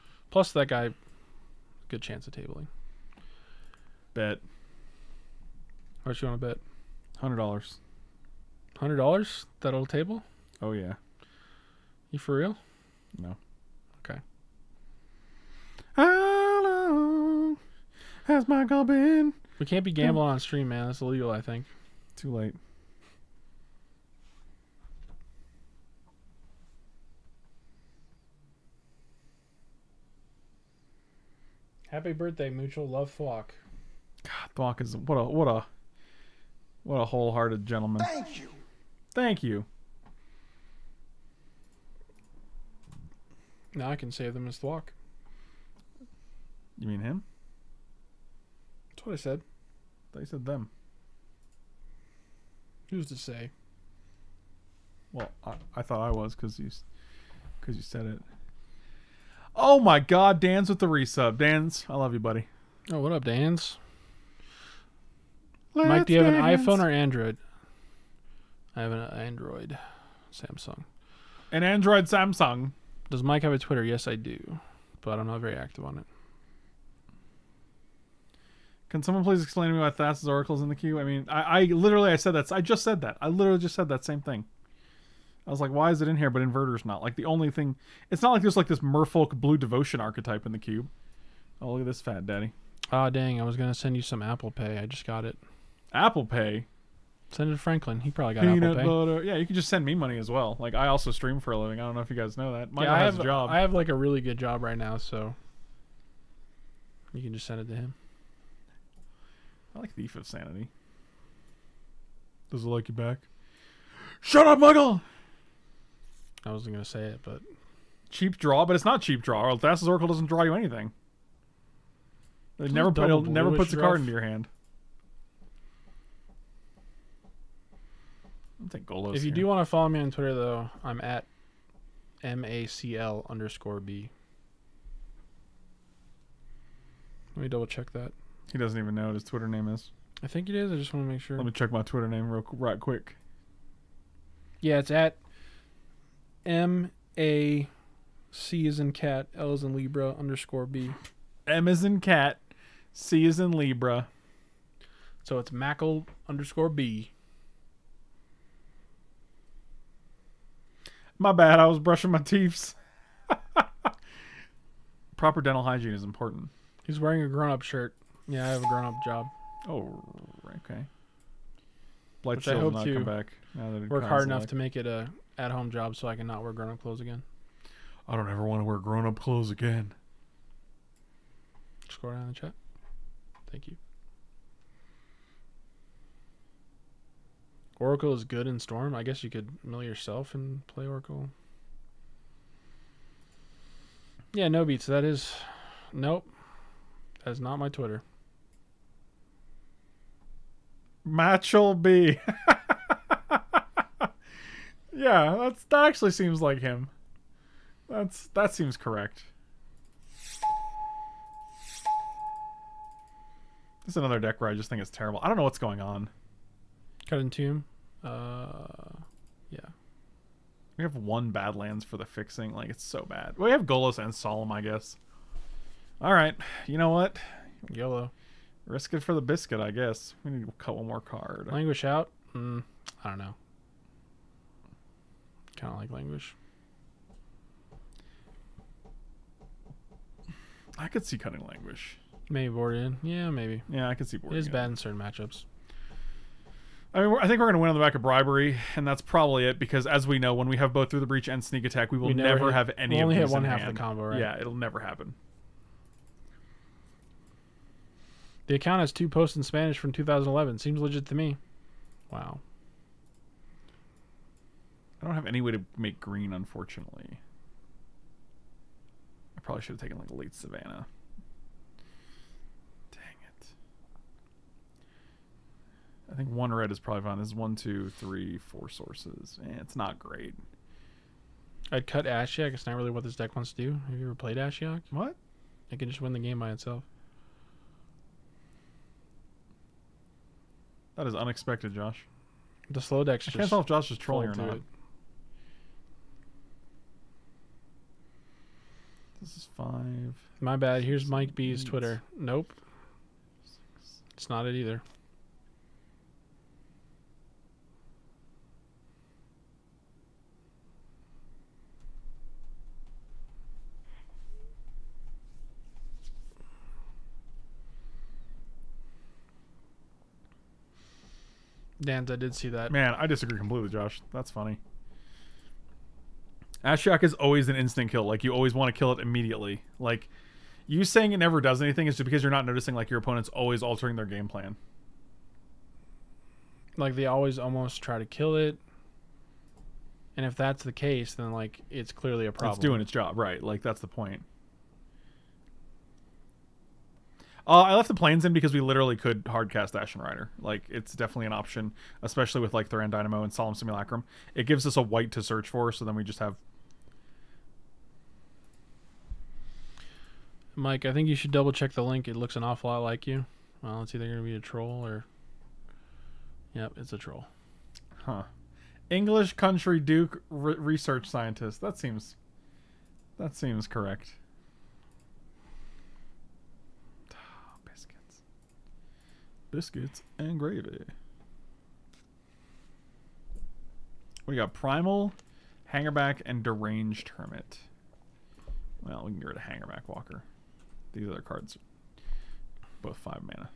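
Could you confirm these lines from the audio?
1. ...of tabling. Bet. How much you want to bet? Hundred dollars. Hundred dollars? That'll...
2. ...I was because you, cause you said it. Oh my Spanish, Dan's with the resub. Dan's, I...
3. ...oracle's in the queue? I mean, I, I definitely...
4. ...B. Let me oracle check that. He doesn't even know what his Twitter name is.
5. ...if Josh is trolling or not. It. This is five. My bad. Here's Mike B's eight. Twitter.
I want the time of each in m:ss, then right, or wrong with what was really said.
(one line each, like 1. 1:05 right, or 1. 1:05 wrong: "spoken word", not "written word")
1. 0:02 right
2. 0:56 wrong: "God", not "Spanish"
3. 1:20 wrong: "literally", not "definitely"
4. 2:13 wrong: "double", not "oracle"
5. 4:53 right.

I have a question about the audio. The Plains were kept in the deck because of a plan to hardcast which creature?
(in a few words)
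Ashen Rider.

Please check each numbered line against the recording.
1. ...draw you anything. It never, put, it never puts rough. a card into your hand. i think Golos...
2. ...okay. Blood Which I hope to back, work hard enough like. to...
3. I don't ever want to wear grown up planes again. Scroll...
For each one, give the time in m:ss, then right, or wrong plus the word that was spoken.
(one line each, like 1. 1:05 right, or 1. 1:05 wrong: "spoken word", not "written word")
1. 2:00 right
2. 2:50 right
3. 2:58 wrong: "clothes", not "planes".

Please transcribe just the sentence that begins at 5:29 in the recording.
Like you saying it never does anything is just because you're not noticing like your opponent's always altering their game plan.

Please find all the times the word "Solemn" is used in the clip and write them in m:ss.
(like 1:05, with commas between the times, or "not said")
3:44, 5:53.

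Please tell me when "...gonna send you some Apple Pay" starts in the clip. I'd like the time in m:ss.
1:33.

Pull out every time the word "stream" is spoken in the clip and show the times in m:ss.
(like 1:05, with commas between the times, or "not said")
0:20, 1:41.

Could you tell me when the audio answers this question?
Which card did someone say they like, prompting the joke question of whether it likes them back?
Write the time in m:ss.
1:49.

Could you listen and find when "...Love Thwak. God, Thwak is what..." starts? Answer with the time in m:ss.
0:32.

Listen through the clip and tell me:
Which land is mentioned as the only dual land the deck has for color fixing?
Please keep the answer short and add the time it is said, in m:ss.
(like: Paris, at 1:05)
Badlands, at 3:41.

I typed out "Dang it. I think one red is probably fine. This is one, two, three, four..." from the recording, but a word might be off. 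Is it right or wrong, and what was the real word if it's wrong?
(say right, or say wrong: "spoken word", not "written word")
right.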